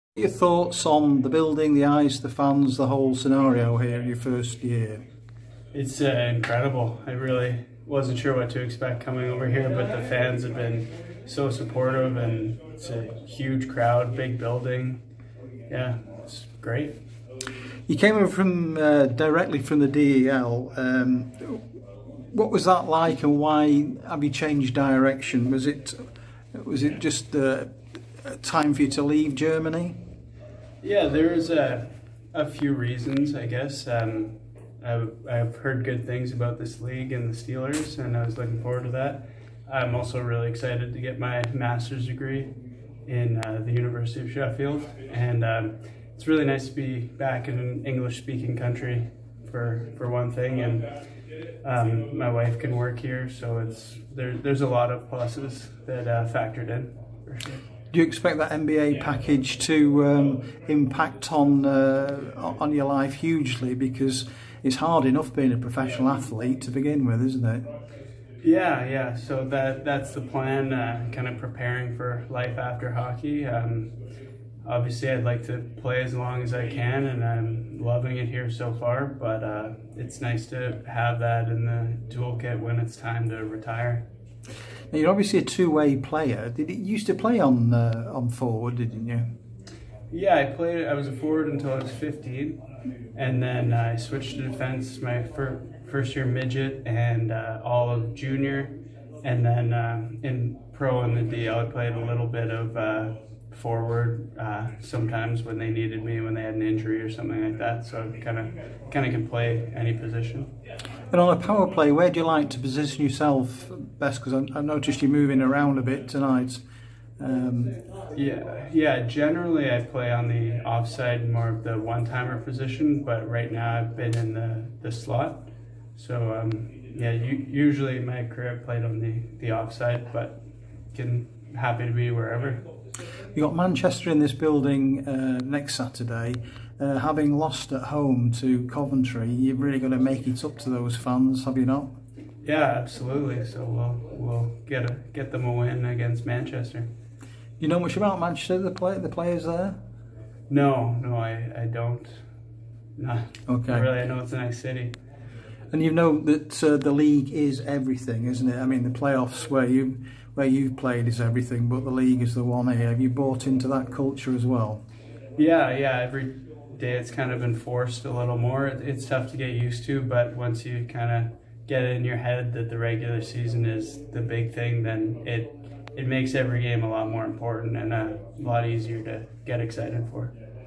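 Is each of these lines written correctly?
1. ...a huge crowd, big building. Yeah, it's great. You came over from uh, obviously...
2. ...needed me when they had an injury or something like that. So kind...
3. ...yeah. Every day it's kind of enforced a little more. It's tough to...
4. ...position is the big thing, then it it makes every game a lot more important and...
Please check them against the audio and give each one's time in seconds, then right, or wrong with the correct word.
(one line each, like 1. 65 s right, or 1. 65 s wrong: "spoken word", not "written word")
1. 12 s wrong: "directly", not "obviously"
2. 105 s right
3. 165 s right
4. 173 s wrong: "season", not "position".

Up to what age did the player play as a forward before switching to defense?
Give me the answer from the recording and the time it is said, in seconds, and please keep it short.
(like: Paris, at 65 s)
15, at 91 s.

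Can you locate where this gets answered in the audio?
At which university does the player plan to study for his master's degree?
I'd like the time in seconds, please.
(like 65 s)
43 s.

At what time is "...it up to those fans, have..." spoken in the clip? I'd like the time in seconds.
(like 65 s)
140 s.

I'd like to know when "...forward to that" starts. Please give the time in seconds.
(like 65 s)
38 s.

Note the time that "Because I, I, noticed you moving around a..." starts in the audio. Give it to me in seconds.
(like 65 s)
114 s.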